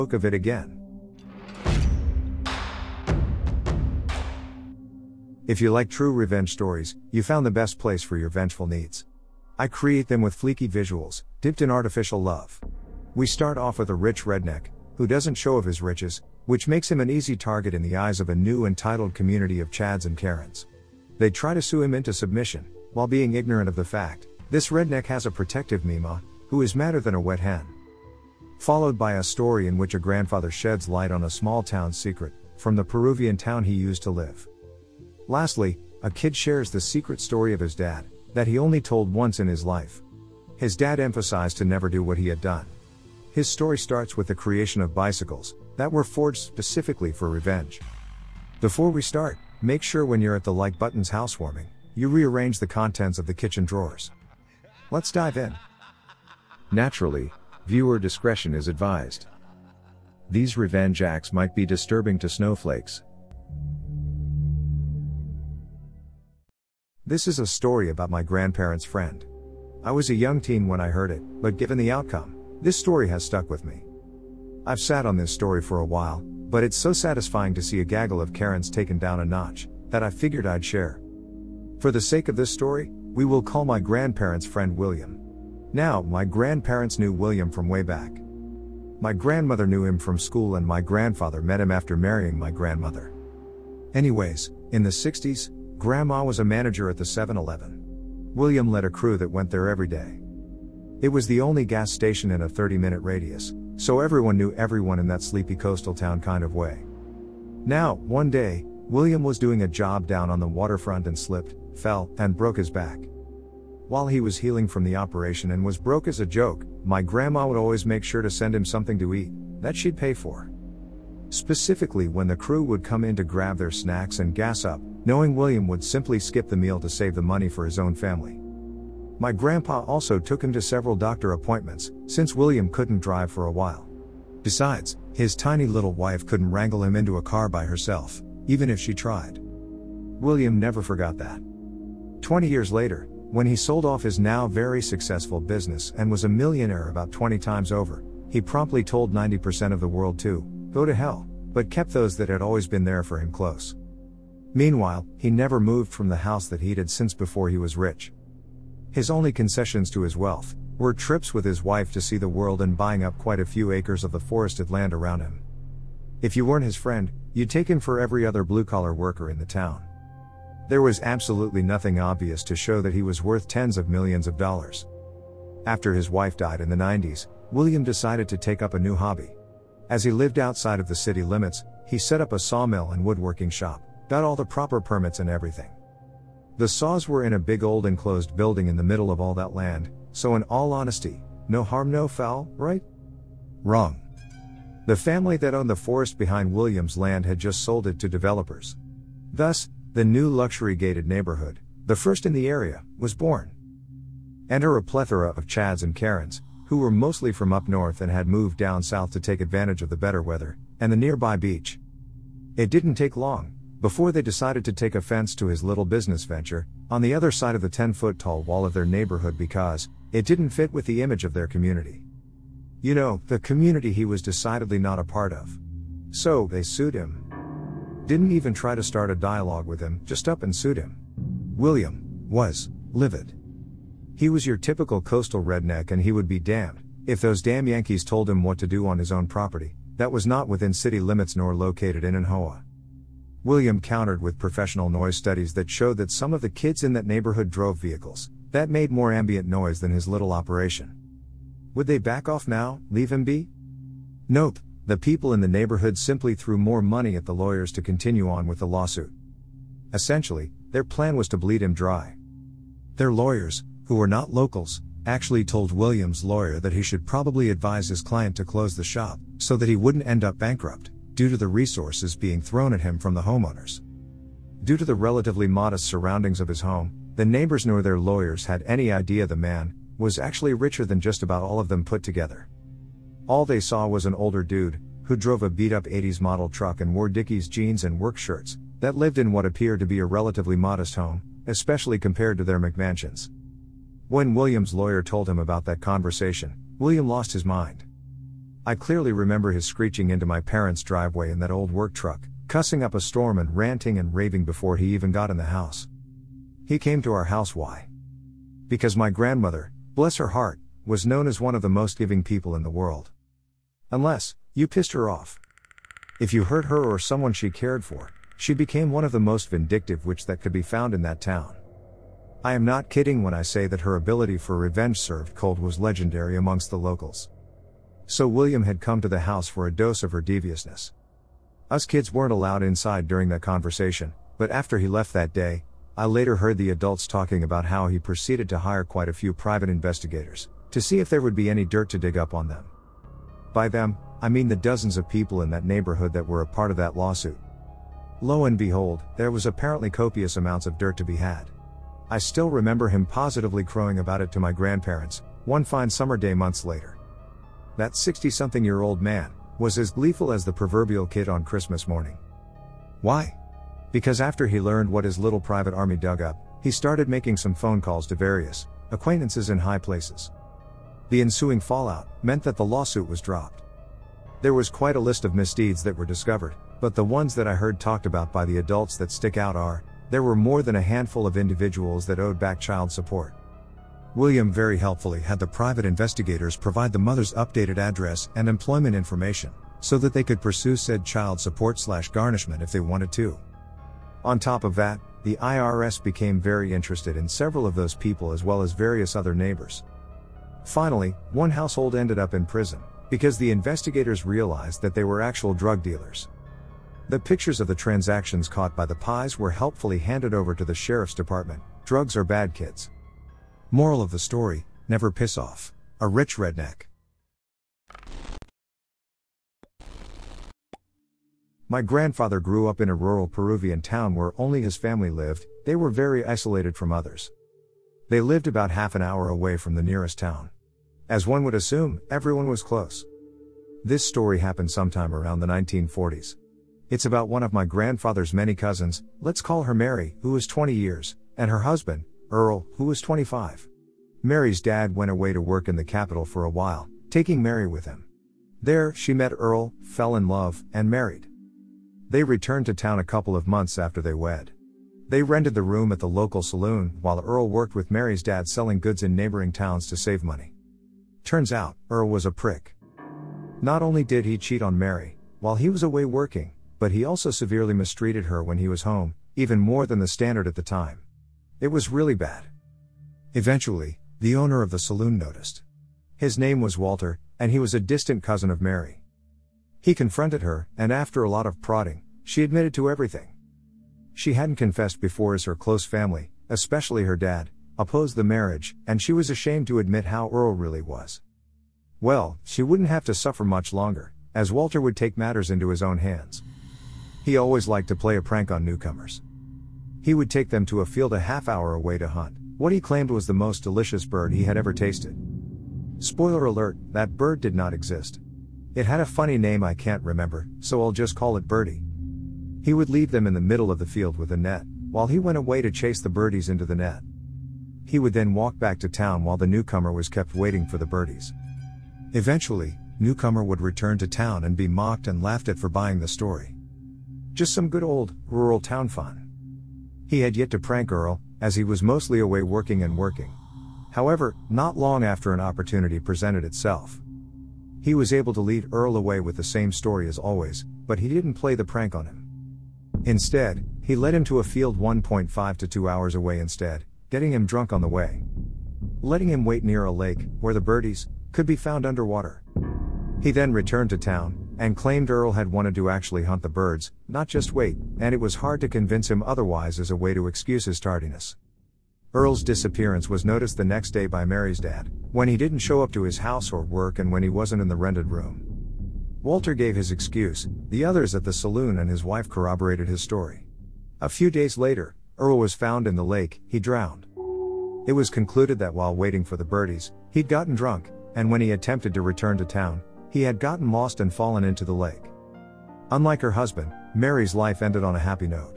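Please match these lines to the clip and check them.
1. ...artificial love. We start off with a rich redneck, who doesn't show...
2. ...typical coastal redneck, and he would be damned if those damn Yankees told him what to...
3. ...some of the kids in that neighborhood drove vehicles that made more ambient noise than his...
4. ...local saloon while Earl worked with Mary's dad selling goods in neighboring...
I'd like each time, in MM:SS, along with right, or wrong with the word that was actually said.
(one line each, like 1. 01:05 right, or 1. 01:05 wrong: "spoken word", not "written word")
1. 00:11 right
2. 03:54 right
3. 04:06 right
4. 07:36 right.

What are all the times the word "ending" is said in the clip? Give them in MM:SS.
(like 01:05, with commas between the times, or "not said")
not said.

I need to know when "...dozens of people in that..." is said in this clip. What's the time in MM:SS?
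05:44.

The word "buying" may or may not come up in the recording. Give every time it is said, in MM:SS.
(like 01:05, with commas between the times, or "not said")
02:42, 08:45.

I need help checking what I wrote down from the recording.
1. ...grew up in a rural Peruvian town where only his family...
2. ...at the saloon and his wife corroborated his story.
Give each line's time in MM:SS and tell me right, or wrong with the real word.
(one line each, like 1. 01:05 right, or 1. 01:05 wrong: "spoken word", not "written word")
1. 07:02 right
2. 09:31 right.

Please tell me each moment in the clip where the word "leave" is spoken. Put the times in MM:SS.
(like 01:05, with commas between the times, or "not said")
04:12, 08:32.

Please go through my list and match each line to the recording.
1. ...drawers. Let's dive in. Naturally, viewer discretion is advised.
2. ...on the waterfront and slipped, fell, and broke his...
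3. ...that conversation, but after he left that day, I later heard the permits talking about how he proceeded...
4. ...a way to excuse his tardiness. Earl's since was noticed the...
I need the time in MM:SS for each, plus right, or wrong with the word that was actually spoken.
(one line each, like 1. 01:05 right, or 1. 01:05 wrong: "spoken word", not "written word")
1. 00:53 right
2. 01:50 right
3. 05:33 wrong: "adults", not "permits"
4. 09:19 wrong: "disappearance", not "since".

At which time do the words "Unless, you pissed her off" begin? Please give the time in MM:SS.
05:13.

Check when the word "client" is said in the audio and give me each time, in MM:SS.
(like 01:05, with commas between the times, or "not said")
04:27.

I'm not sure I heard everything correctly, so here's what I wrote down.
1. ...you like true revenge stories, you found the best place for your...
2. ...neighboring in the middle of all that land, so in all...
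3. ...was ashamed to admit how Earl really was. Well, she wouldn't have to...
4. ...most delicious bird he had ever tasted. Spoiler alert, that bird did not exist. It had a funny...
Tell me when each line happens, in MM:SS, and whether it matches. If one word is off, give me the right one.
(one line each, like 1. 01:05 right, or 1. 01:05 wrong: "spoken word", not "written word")
1. 00:05 right
2. 03:08 wrong: "building", not "neighboring"
3. 08:09 right
4. 08:23 right.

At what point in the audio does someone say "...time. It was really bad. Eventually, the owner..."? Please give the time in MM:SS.
07:50.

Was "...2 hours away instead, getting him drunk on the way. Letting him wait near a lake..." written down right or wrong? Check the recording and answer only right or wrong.
right.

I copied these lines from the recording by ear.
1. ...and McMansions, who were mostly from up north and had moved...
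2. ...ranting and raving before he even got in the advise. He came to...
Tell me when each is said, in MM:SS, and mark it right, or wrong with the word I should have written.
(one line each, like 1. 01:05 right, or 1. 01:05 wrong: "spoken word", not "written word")
1. 03:25 wrong: "Karens", not "McMansions"
2. 05:03 wrong: "house", not "advise".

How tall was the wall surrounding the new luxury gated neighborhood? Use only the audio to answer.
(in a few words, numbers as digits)
10 foot.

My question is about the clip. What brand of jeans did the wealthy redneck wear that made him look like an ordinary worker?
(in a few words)
Dickies.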